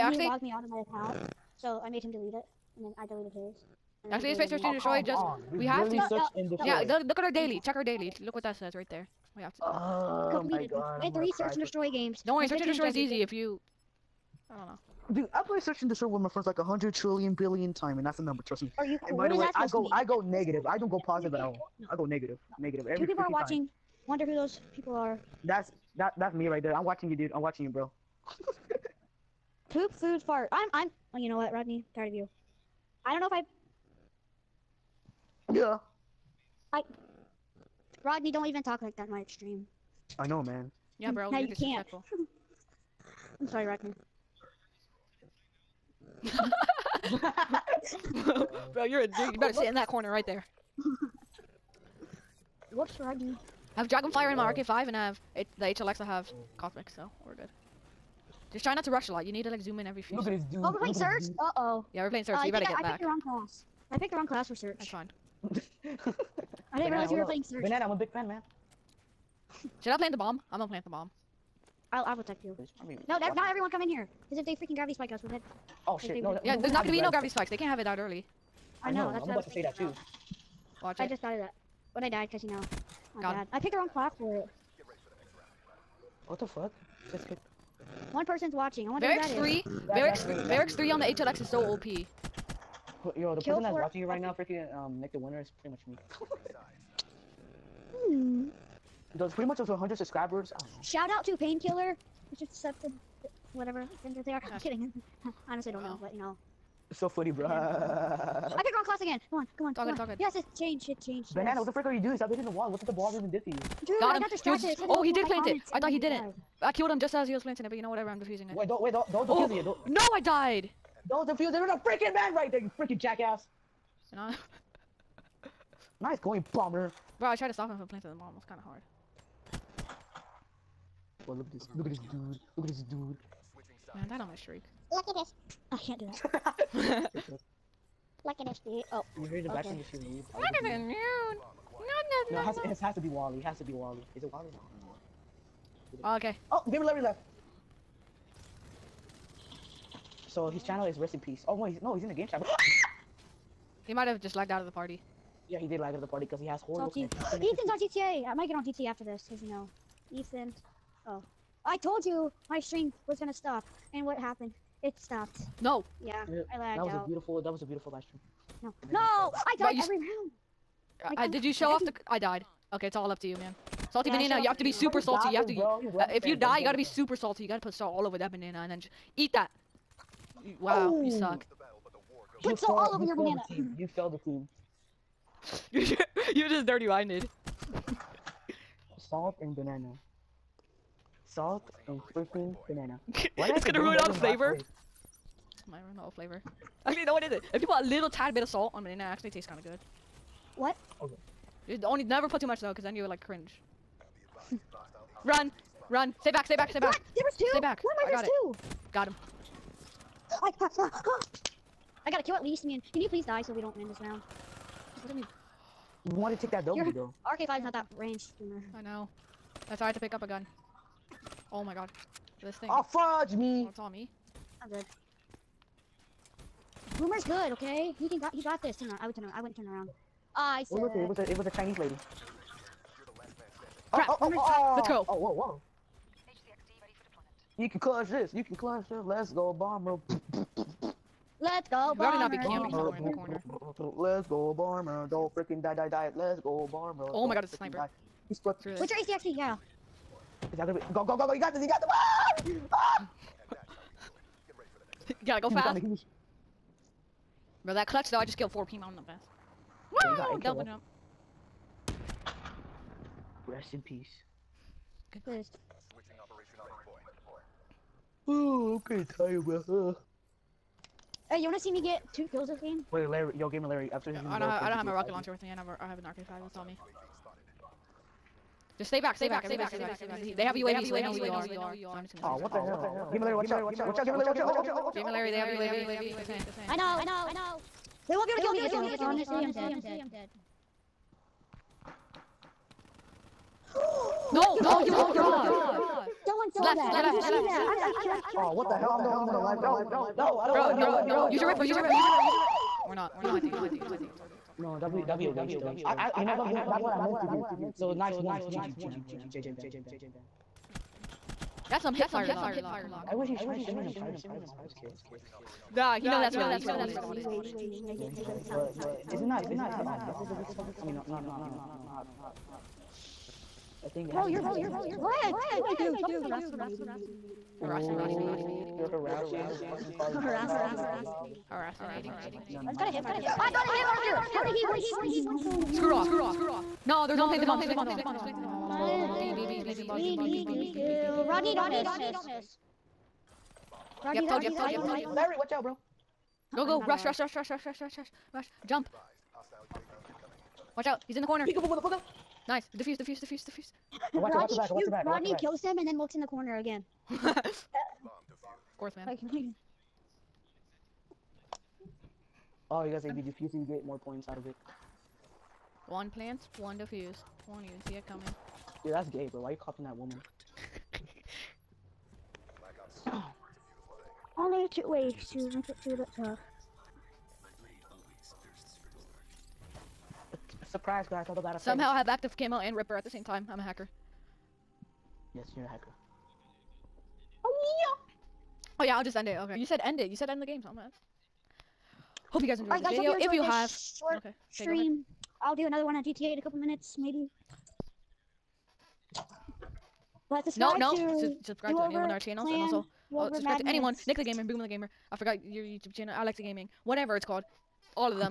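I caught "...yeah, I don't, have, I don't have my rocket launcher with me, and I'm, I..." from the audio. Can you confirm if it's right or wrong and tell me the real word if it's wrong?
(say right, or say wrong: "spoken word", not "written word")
right.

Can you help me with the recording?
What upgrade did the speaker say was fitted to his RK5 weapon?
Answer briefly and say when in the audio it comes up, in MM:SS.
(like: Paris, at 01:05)
Dragonfire, at 00:53.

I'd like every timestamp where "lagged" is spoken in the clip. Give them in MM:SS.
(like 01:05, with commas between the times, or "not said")
02:34, 02:46.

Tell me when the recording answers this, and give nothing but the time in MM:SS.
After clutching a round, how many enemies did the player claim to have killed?
04:18.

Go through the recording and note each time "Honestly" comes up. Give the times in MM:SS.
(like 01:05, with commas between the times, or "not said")
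01:45, 04:48.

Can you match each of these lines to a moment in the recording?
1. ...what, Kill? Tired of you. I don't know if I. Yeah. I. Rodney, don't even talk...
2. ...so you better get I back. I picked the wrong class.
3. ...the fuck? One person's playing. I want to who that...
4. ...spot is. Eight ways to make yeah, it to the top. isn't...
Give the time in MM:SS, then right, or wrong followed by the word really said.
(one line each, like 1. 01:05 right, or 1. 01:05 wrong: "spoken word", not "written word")
1. 00:31 wrong: "Rodney", not "Kill"
2. 01:02 right
3. 01:26 wrong: "watching", not "playing"
4. 05:16 wrong: "Two", not "Eight".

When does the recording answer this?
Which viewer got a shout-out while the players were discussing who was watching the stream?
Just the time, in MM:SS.
01:41.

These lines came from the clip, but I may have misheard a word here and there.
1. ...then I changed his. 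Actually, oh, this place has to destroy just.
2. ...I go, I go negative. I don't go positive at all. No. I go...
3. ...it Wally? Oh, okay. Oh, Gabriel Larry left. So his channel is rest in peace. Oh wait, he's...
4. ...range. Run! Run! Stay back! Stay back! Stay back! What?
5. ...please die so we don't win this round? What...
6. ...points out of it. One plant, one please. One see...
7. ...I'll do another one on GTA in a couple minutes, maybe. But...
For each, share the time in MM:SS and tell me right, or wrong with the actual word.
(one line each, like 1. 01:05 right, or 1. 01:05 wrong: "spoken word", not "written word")
1. 00:02 wrong: "deleted", not "changed"
2. 00:19 right
3. 02:24 right
4. 03:23 wrong: "cringe", not "range"
5. 03:33 right
6. 06:03 wrong: "defuse", not "please"
7. 06:35 right.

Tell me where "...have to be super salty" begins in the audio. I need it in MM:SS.
02:54.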